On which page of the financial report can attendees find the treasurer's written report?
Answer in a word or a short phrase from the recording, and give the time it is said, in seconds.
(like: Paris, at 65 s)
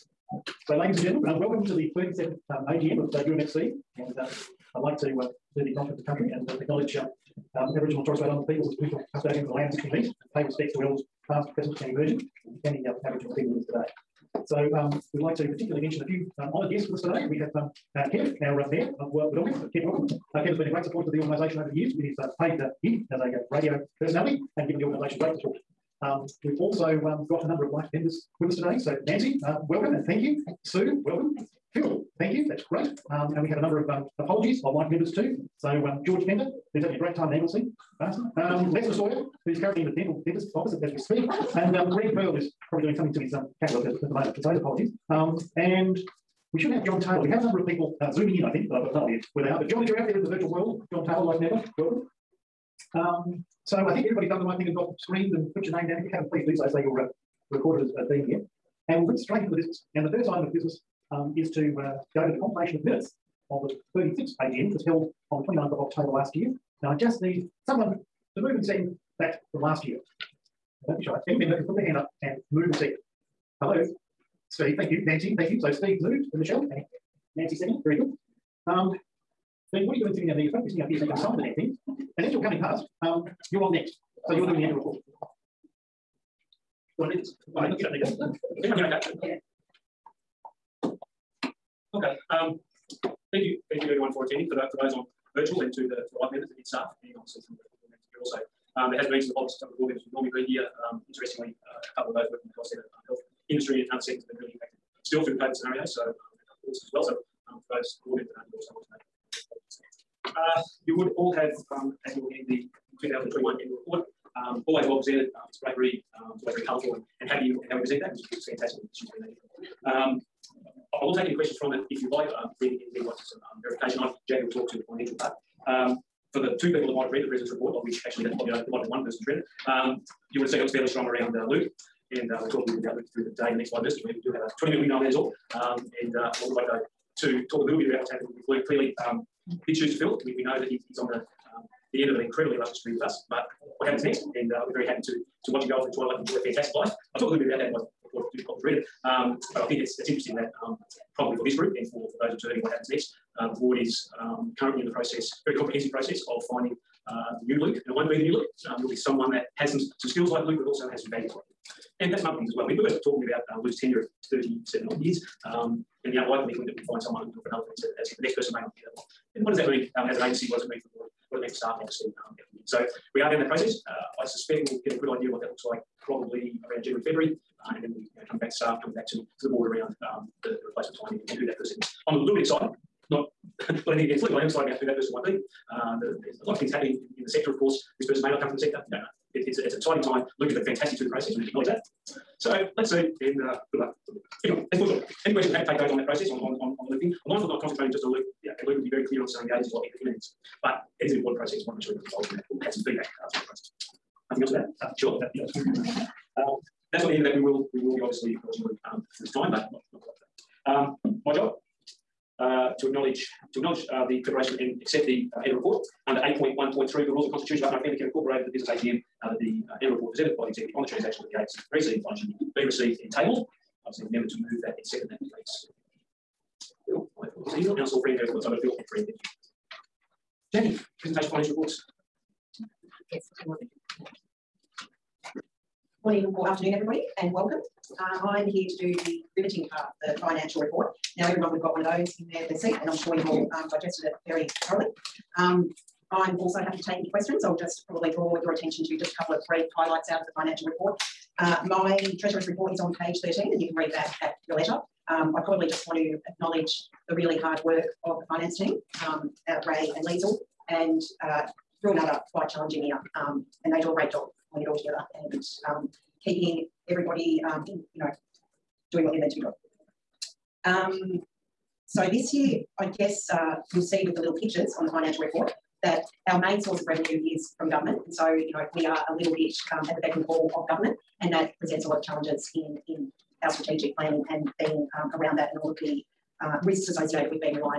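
13, at 252 s.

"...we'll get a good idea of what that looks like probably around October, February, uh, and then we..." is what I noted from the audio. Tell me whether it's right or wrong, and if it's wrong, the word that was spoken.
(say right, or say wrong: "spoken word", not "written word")
wrong: "January", not "October".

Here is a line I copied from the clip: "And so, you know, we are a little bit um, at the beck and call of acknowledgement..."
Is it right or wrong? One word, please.
wrong.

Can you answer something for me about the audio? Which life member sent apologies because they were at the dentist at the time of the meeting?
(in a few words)
Lester Sawyer.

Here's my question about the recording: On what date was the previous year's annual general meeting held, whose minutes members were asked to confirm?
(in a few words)
29 October.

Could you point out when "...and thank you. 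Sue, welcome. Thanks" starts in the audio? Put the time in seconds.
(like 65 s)
29 s.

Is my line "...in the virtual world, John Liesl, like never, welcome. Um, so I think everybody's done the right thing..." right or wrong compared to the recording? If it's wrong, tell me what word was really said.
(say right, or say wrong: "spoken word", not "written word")
wrong: "Taylor", not "Liesl".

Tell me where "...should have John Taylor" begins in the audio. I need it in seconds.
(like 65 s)
46 s.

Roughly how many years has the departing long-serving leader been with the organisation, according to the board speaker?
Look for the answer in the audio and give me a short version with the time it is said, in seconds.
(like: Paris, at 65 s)
37, at 164 s.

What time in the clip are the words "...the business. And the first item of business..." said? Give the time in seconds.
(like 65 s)
59 s.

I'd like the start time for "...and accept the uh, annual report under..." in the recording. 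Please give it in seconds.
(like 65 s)
214 s.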